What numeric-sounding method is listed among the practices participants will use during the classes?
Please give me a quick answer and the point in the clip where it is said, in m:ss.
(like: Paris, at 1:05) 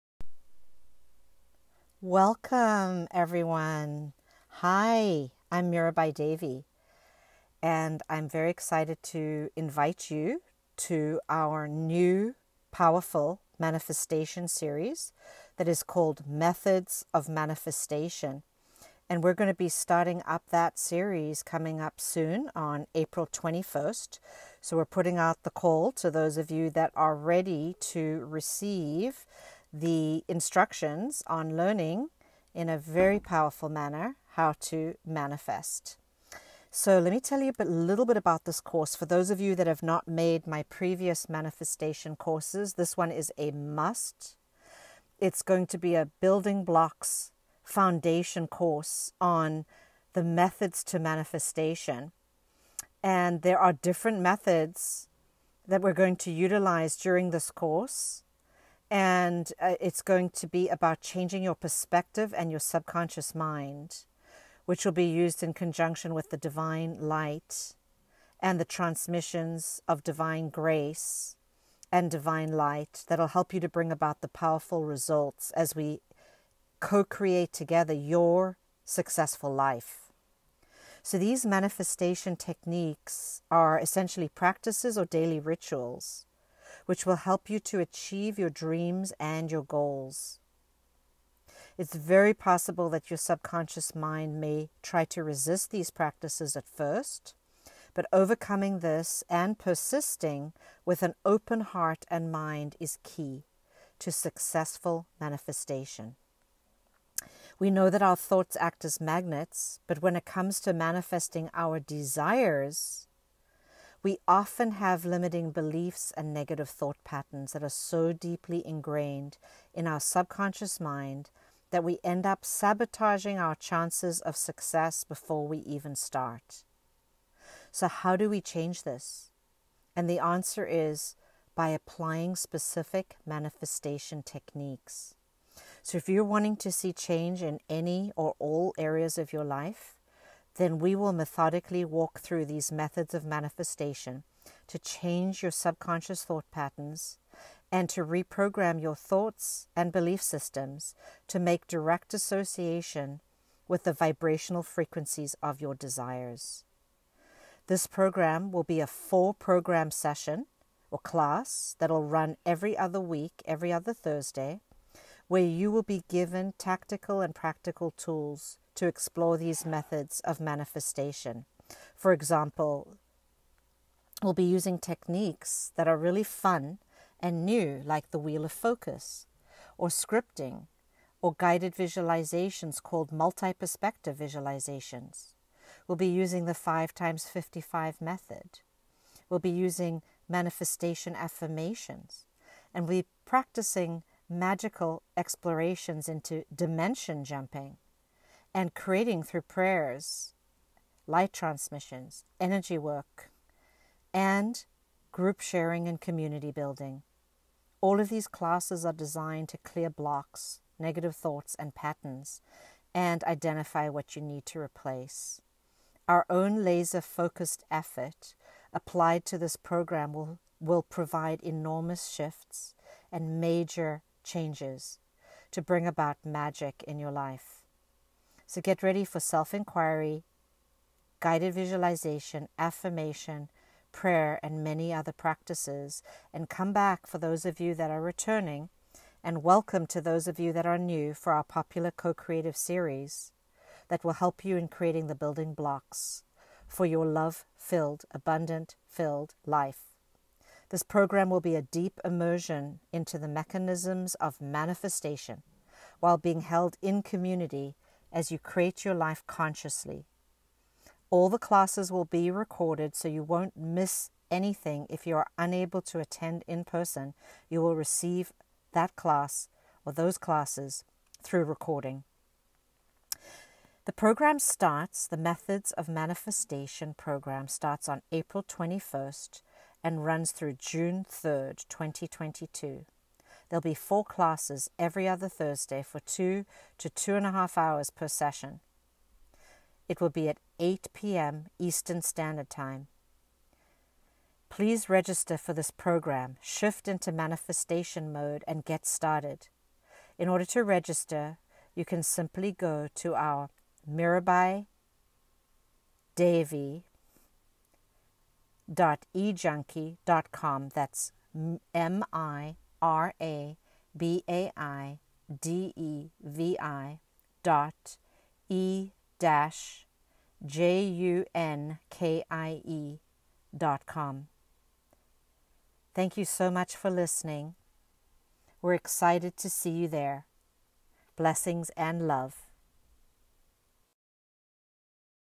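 5 times 55 method, at 3:06.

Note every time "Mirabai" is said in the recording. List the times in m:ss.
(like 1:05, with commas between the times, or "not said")
0:05, 5:03.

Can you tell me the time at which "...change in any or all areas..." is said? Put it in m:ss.
2:16.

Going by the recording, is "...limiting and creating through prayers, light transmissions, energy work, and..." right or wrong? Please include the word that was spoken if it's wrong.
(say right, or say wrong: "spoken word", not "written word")
wrong: "jumping", not "limiting".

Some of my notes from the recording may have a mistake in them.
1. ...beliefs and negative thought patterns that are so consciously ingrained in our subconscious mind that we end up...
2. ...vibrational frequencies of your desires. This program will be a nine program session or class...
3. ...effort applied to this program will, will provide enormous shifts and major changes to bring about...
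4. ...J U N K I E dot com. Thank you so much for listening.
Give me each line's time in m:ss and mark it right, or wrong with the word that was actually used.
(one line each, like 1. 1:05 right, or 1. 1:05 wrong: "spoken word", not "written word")
1. 1:55 wrong: "deeply", not "consciously"
2. 2:33 wrong: "four", not "nine"
3. 3:37 right
4. 5:20 right.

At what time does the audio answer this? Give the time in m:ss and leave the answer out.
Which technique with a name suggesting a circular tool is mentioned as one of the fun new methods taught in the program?
2:58.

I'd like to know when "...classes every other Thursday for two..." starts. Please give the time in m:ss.
4:44.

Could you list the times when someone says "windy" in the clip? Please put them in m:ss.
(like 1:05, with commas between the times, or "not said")
not said.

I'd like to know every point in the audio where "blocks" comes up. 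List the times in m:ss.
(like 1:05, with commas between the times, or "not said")
0:46, 3:29, 4:05.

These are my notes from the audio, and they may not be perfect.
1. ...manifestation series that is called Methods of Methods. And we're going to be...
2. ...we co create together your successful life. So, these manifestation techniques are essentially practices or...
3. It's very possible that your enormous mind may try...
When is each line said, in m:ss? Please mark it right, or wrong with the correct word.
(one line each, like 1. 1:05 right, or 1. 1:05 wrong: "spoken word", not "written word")
1. 0:13 wrong: "Manifestation", not "Methods"
2. 1:15 right
3. 1:31 wrong: "subconscious", not "enormous".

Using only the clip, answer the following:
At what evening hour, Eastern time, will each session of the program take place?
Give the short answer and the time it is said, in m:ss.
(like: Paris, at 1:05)
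8 p.m., at 4:50.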